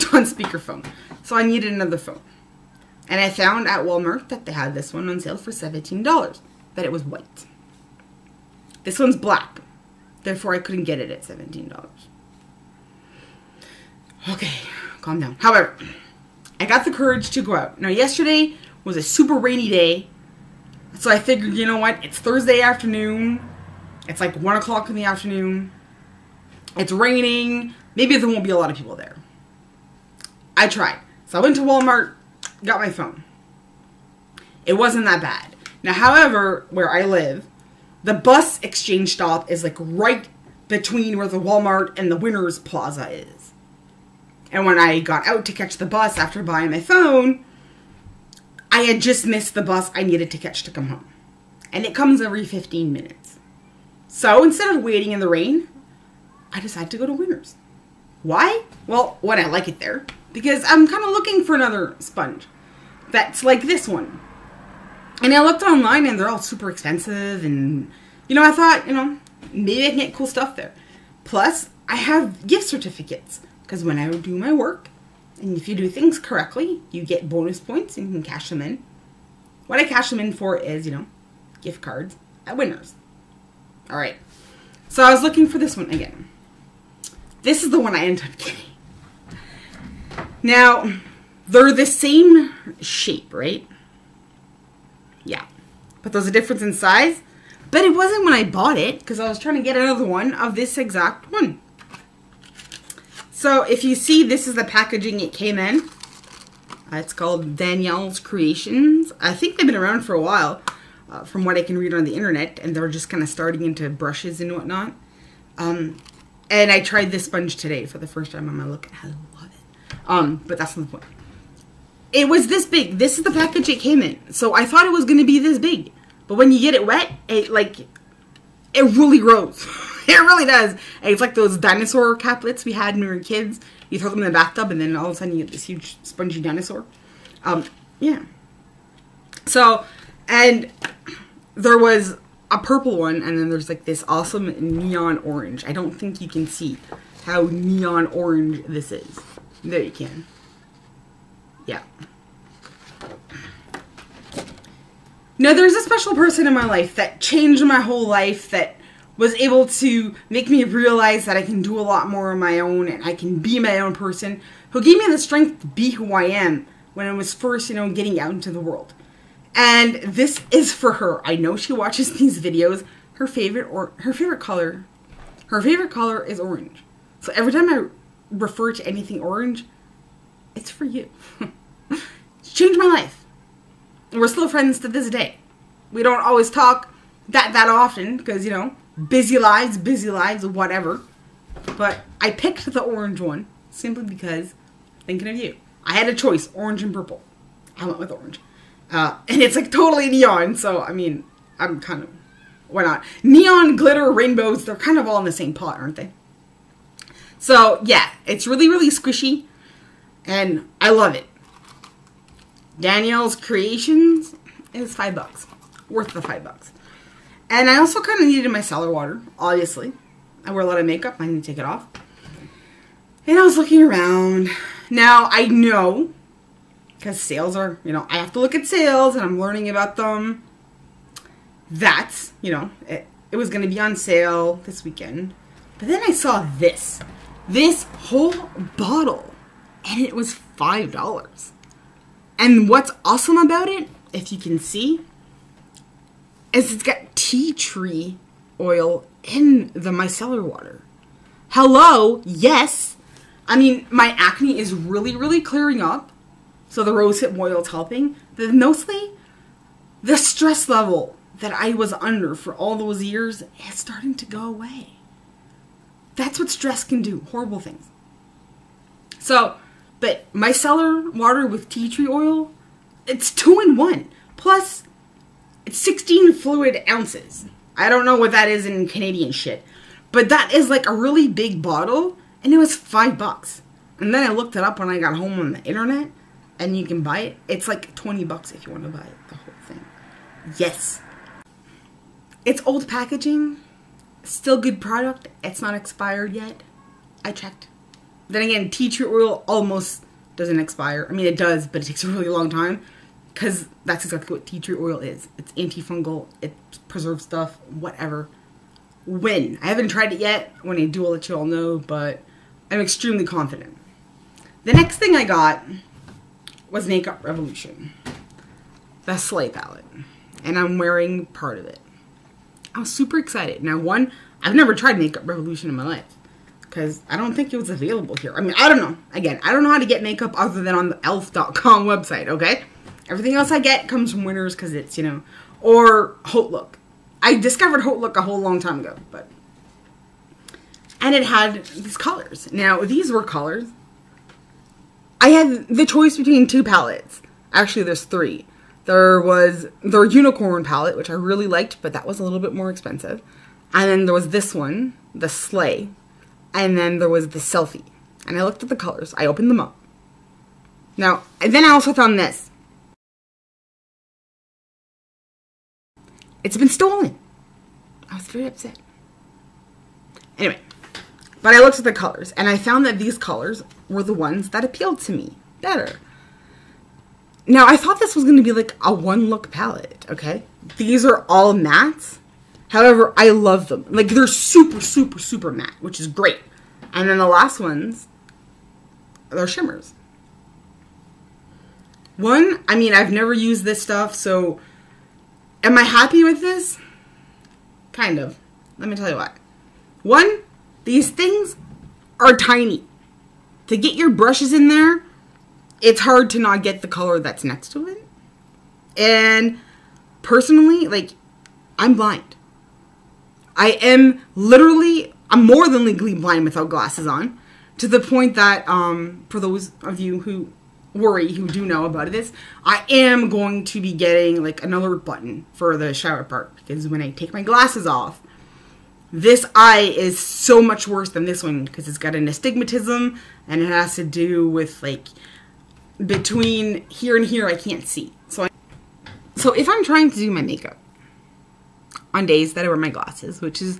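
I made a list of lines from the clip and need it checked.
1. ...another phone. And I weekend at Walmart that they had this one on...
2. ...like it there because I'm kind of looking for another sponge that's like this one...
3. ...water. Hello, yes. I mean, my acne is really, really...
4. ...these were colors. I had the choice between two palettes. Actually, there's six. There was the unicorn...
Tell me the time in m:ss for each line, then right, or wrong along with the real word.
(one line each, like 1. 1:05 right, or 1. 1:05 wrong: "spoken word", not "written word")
1. 0:01 wrong: "found", not "weekend"
2. 0:59 right
3. 4:10 right
4. 5:42 wrong: "three", not "six".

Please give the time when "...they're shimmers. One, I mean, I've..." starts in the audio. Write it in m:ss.
6:29.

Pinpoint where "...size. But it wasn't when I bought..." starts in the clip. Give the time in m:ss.
1:36.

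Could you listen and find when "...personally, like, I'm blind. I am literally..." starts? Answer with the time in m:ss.
6:50.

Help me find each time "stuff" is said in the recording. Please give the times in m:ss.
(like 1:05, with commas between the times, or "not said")
1:10, 5:07, 6:33.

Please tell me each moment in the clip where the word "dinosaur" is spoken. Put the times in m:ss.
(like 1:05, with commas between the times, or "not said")
2:11, 2:16.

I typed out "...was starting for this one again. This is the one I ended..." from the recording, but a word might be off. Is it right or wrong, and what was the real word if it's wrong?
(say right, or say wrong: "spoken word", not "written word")
wrong: "looking", not "starting".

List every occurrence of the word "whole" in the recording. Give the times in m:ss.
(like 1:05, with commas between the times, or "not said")
2:37, 3:57, 4:49, 5:38.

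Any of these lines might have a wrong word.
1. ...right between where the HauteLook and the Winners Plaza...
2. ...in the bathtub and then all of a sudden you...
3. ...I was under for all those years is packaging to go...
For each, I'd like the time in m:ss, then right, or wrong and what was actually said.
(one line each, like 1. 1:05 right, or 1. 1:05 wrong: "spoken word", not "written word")
1. 0:39 wrong: "Walmart", not "HauteLook"
2. 2:14 right
3. 4:21 wrong: "starting", not "packaging".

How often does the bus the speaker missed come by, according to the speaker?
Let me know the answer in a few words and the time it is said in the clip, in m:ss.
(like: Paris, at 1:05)
Every 15 minutes, at 0:52.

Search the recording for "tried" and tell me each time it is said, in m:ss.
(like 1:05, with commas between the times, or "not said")
0:30, 1:56, 5:09, 5:24.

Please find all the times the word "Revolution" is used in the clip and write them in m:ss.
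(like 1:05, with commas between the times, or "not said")
5:17, 5:25.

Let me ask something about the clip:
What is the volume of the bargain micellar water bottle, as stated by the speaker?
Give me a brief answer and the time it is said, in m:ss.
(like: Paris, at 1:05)
16 fluid ounces, at 4:35.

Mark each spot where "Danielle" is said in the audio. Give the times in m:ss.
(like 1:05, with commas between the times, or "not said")
1:47, 3:32.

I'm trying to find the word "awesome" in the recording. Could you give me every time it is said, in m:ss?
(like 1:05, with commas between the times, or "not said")
2:24, 4:03.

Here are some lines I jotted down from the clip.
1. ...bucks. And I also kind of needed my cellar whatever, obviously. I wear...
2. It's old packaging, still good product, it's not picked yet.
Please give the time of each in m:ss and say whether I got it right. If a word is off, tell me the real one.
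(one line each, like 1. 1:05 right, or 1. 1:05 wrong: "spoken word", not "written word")
1. 3:36 wrong: "water", not "whatever"
2. 4:52 wrong: "expired", not "picked".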